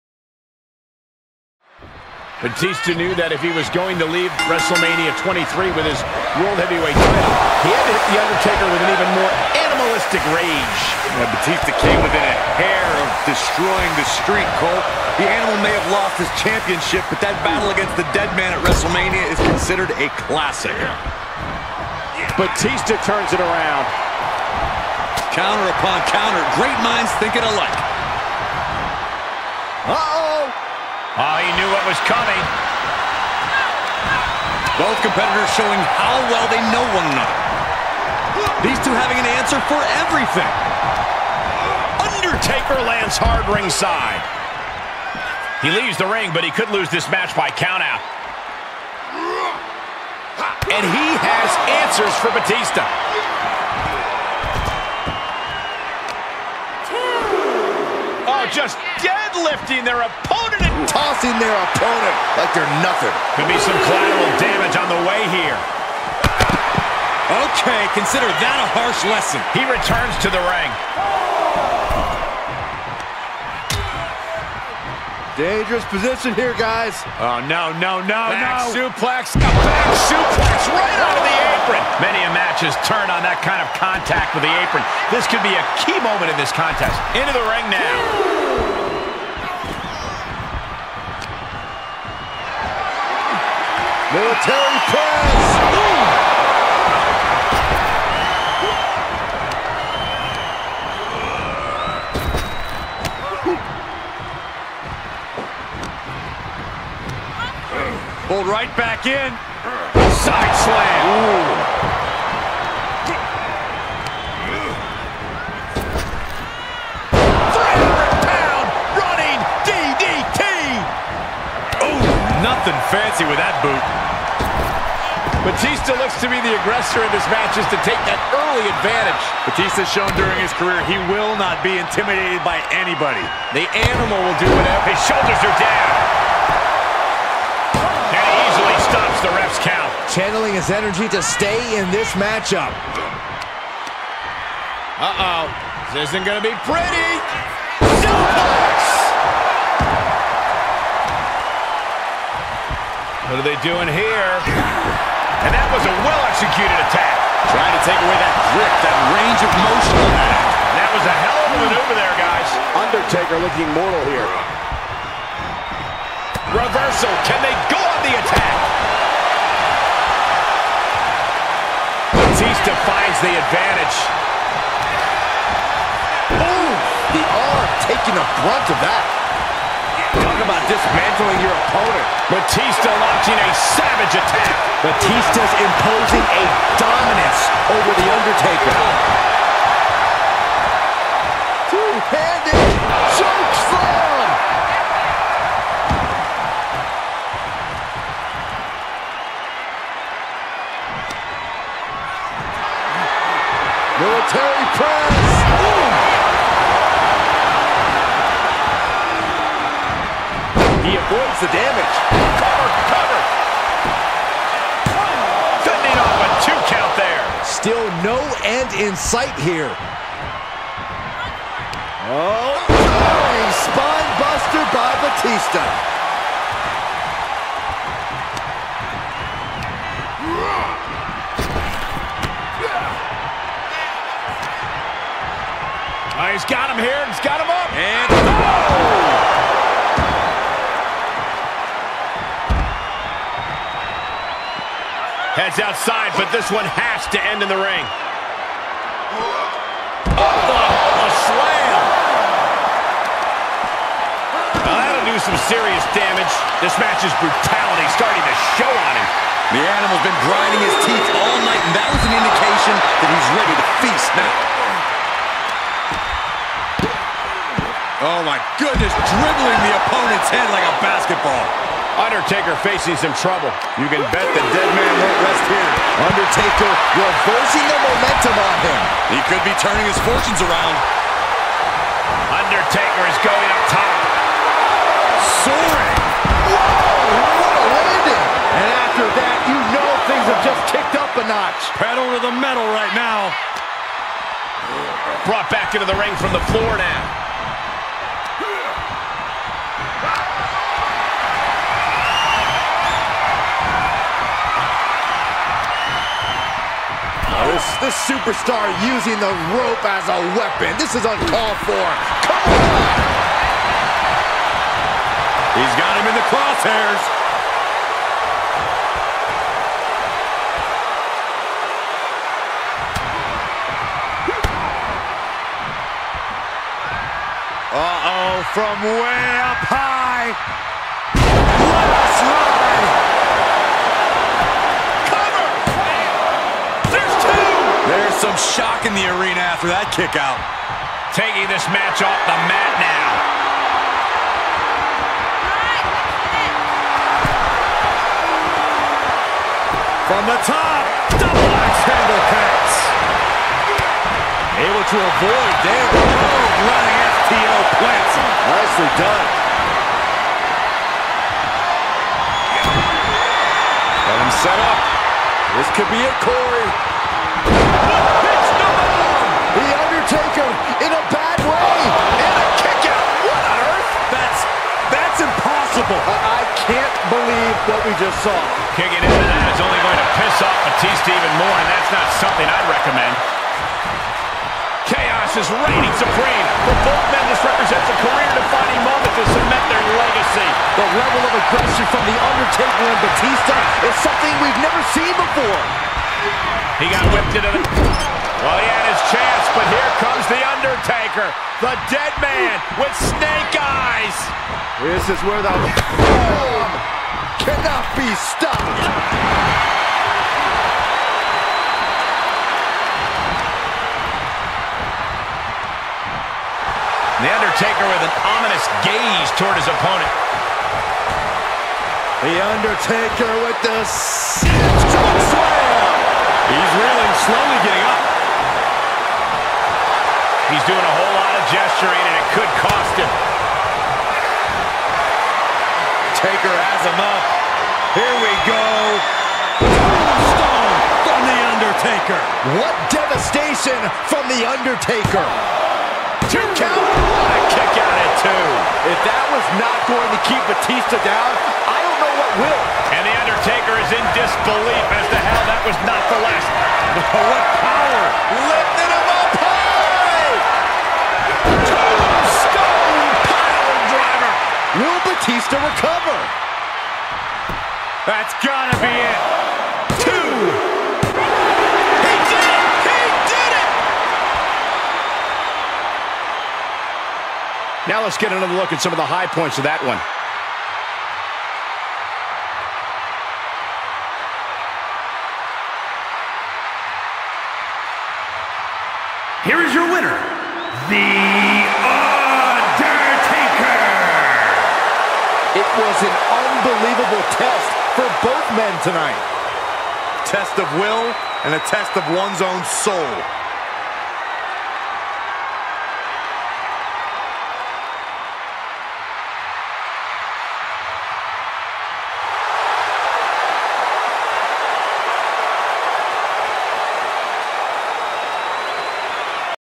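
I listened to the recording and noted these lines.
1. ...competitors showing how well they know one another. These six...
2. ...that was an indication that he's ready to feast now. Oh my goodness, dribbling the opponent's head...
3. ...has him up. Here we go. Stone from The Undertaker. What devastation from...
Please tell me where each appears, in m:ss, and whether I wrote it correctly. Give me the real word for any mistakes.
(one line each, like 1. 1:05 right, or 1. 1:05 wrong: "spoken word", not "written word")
1. 0:35 wrong: "two", not "six"
2. 4:21 right
3. 7:16 right.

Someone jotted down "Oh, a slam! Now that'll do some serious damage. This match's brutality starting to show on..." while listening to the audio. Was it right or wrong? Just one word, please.
right.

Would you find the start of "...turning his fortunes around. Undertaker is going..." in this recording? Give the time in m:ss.
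4:39.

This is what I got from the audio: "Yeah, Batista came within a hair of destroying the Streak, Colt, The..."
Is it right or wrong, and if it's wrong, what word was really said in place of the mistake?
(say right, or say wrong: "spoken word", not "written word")
right.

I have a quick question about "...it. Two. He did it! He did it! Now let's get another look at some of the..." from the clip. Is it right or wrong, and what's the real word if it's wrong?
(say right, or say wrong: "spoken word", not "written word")
right.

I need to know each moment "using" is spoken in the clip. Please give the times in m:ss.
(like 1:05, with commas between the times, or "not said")
5:08.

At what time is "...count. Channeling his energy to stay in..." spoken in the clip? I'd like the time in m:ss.
2:19.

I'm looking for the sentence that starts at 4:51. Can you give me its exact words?
Pedal to the metal right now.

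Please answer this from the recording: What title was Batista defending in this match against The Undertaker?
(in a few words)
World Heavyweight title.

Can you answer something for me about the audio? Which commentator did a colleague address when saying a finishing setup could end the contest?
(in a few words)
Corey.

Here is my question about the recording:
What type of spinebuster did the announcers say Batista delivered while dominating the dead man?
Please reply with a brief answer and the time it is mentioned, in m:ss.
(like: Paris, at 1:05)
Soaring spine buster, at 3:42.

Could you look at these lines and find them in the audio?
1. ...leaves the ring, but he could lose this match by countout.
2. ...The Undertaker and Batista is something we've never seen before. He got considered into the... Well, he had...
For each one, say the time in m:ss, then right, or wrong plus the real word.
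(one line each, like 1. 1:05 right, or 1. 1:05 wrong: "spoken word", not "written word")
1. 0:45 right
2. 6:32 wrong: "whipped", not "considered".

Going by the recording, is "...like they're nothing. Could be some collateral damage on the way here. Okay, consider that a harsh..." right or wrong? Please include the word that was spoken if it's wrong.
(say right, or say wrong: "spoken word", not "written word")
right.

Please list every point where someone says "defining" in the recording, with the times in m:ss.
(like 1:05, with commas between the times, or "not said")
6:28.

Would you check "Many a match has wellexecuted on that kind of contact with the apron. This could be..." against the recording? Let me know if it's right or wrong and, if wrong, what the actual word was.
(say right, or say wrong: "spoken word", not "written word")
wrong: "turned", not "wellexecuted".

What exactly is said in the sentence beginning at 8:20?
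Test of will and a test of one's own soul.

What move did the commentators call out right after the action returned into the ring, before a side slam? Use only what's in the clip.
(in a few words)
Military press.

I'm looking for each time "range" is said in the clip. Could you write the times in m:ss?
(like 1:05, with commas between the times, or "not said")
2:39.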